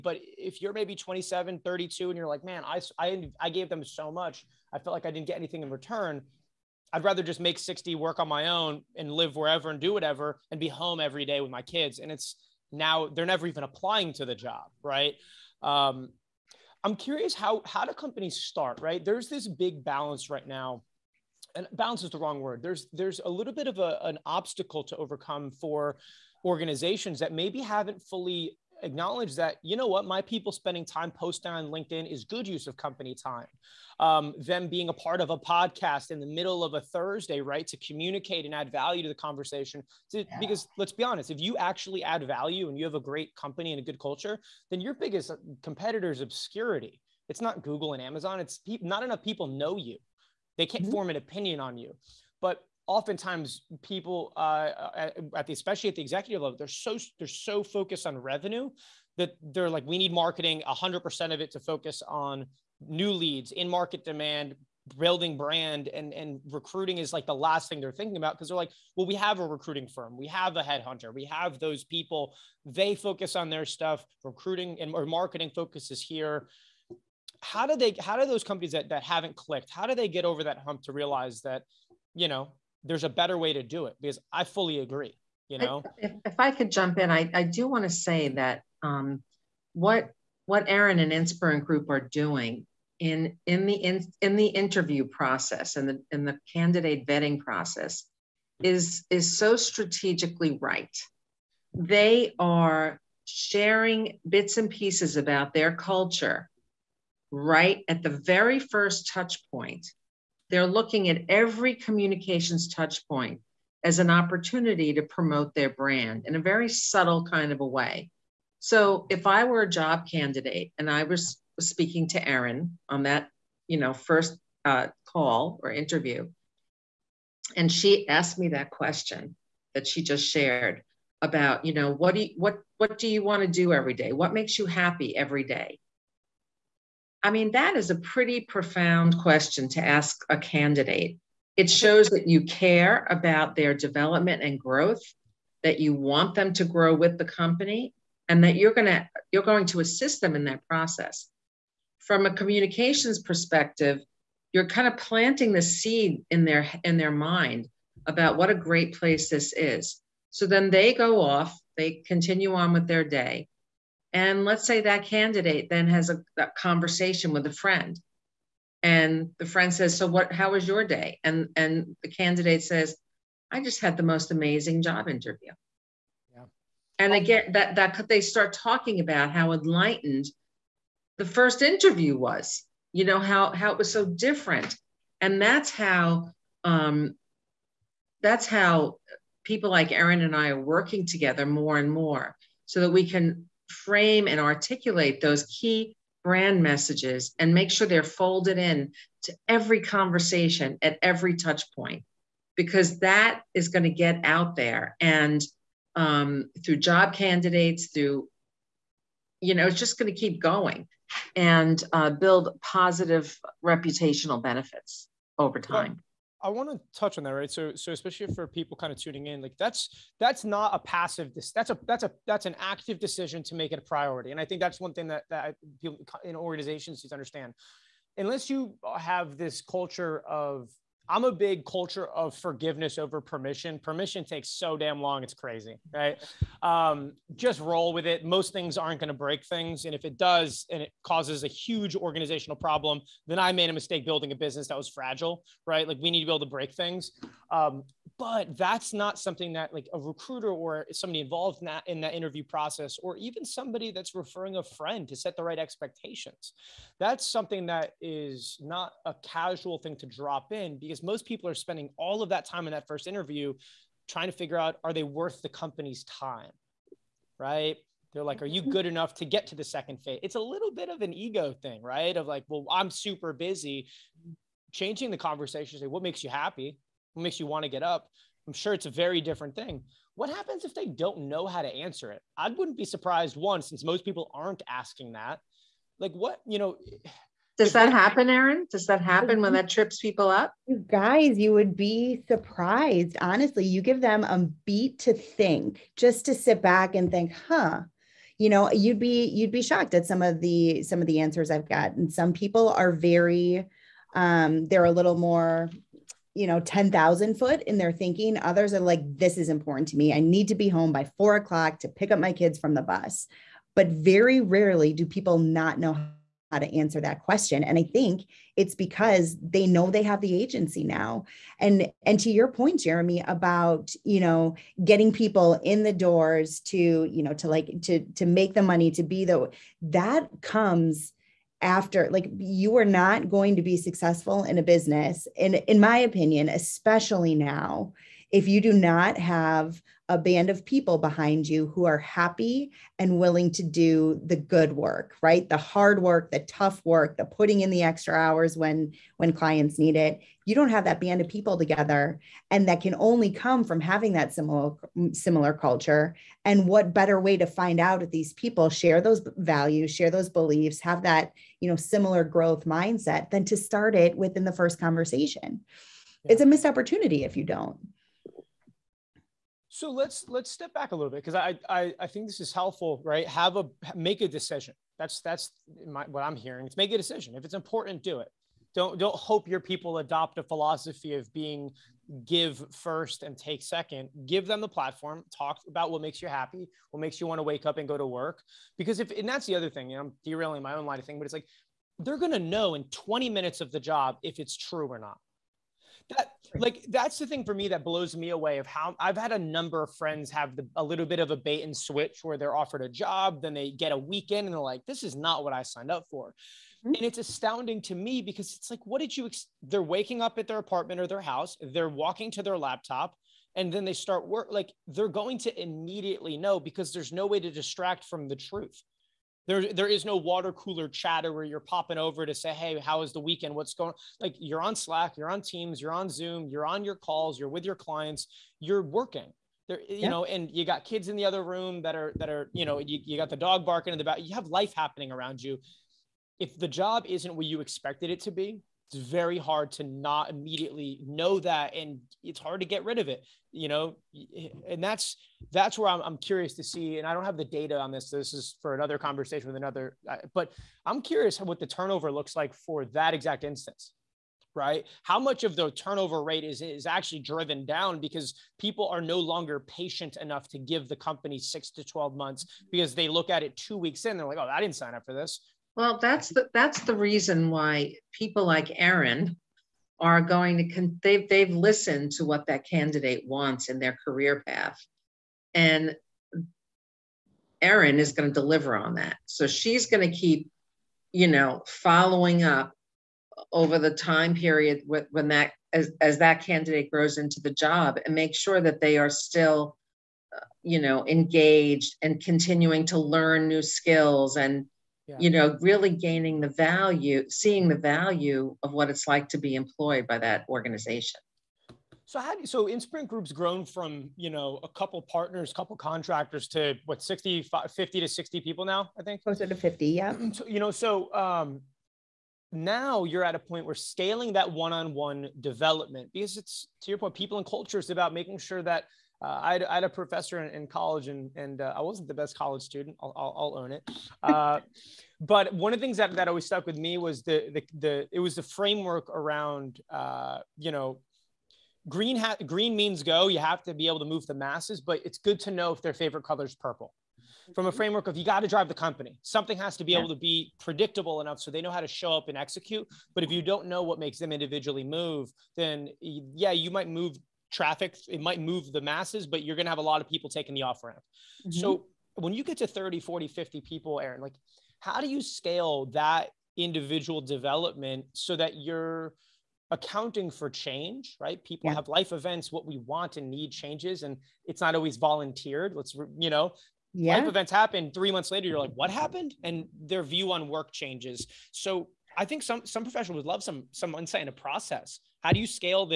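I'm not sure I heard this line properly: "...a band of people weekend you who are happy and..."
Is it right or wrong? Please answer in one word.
wrong.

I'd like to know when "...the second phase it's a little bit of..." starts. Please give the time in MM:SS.
04:29.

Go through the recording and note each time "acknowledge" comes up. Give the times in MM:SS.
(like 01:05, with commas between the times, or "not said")
00:28.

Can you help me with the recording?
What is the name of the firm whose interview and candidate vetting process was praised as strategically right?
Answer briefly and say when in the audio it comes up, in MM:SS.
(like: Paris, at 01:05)
Inspirant Group, at 01:31.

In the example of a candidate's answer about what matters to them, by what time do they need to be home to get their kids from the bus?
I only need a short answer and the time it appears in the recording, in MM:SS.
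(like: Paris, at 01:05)
4 o'clock, at 05:11.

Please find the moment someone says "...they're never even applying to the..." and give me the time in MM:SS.
00:13.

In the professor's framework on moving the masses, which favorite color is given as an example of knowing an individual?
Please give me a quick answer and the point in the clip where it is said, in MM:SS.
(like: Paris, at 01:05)
purple, at 08:56.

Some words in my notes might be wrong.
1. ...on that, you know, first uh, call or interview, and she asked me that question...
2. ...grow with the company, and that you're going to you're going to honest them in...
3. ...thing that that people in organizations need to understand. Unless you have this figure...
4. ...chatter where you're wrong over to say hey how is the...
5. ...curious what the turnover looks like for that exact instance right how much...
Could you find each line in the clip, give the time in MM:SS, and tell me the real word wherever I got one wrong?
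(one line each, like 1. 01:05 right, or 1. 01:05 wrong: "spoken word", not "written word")
1. 02:02 right
2. 02:26 wrong: "assist", not "honest"
3. 03:44 wrong: "culture", not "figure"
4. 07:00 wrong: "popping", not "wrong"
5. 07:31 right.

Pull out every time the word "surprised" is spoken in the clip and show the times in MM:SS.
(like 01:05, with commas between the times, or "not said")
04:42, 04:52.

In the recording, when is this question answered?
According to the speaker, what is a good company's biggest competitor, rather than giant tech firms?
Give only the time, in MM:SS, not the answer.
00:46.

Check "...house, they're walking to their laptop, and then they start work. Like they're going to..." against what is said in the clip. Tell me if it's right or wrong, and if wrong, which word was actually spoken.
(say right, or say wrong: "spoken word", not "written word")
right.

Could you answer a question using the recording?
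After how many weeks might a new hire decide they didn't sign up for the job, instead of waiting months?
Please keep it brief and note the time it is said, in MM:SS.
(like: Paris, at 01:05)
2, at 07:43.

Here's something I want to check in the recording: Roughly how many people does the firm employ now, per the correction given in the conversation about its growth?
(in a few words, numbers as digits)
closer to 50.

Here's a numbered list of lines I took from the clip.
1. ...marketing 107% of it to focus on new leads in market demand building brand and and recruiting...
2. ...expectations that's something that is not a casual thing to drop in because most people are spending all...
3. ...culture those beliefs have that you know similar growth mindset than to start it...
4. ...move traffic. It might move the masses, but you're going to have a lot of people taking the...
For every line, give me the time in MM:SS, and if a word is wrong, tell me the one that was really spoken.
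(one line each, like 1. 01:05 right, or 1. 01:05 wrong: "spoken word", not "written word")
1. 01:00 wrong: "100", not "107"
2. 04:15 right
3. 05:59 wrong: "share", not "culture"
4. 09:06 right.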